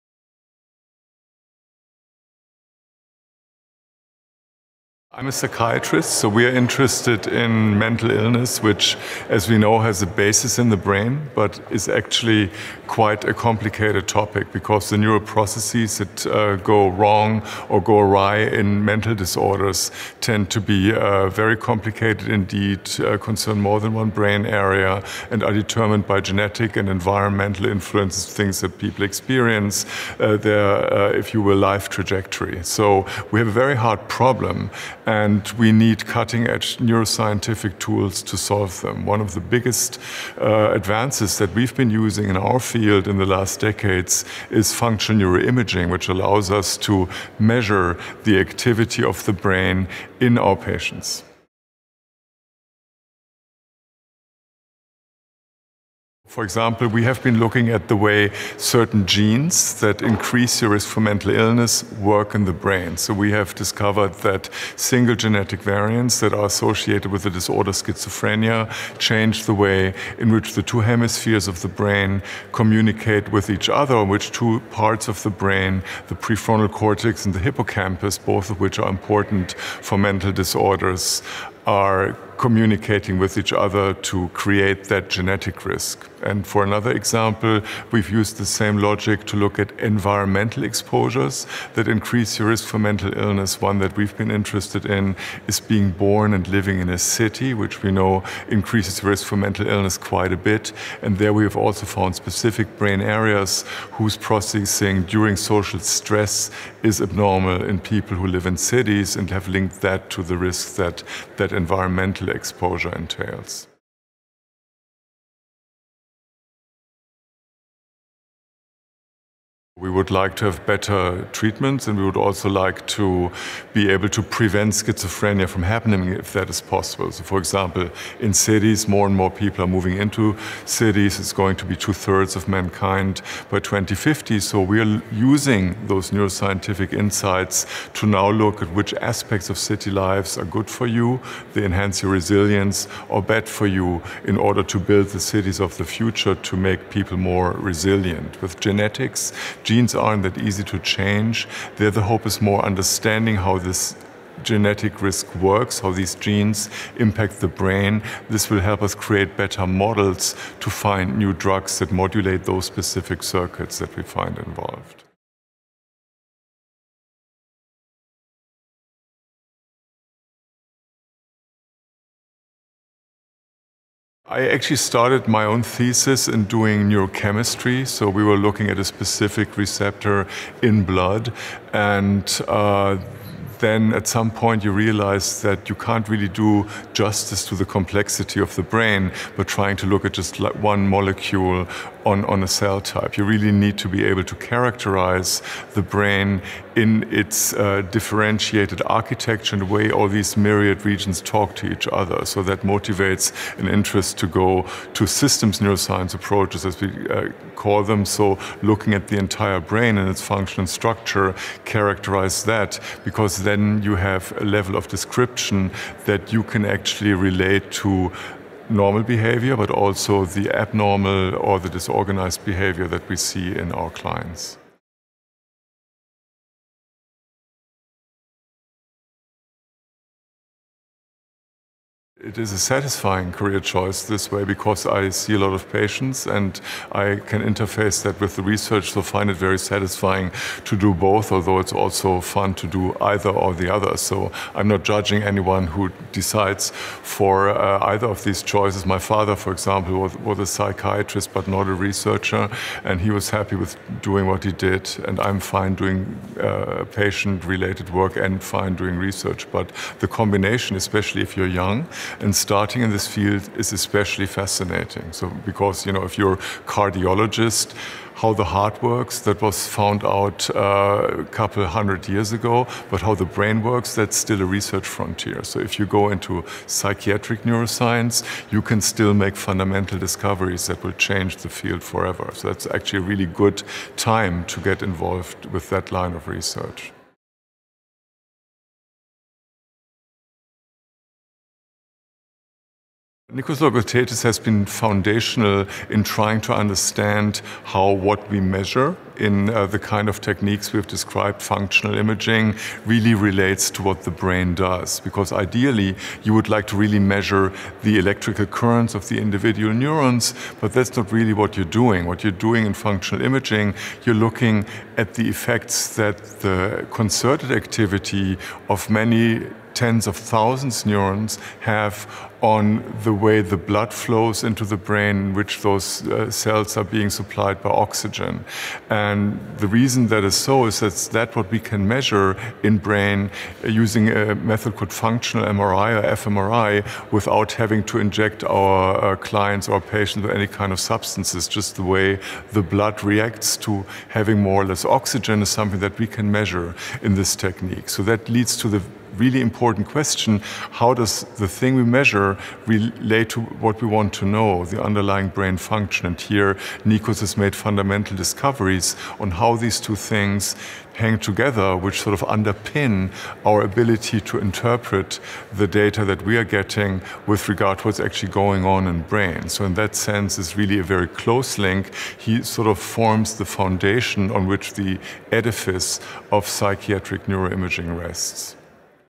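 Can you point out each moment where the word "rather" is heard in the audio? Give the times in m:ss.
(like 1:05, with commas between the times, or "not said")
not said.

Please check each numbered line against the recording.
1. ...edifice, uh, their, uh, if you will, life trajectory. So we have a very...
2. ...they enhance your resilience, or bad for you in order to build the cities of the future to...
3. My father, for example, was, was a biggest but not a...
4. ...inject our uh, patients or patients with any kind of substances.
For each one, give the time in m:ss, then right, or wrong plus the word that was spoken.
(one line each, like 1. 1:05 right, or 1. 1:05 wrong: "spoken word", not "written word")
1. 0:29 wrong: "experience", not "edifice"
2. 2:21 right
3. 4:08 wrong: "psychiatrist", not "biggest"
4. 5:37 wrong: "clients", not "patients".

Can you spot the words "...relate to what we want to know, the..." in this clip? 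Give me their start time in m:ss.
5:52.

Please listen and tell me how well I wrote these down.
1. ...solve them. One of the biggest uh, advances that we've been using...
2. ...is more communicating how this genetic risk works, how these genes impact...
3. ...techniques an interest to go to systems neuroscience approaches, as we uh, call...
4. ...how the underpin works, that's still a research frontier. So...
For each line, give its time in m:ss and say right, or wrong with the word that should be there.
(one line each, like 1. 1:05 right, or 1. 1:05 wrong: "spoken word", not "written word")
1. 0:38 right
2. 2:32 wrong: "understanding", not "communicating"
3. 3:22 wrong: "motivates", not "techniques"
4. 4:33 wrong: "brain", not "underpin".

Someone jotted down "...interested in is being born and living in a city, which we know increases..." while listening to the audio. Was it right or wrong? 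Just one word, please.
right.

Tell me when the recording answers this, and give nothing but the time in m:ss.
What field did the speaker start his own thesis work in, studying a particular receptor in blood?
2:56.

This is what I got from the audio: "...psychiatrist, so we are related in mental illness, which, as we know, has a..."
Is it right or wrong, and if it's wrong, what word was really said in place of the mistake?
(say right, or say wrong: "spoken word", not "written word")
wrong: "interested", not "related".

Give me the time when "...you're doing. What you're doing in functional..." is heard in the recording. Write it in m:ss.
5:11.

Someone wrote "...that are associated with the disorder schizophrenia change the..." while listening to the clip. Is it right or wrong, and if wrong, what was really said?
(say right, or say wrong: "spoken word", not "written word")
right.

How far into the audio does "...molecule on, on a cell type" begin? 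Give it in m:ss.
3:10.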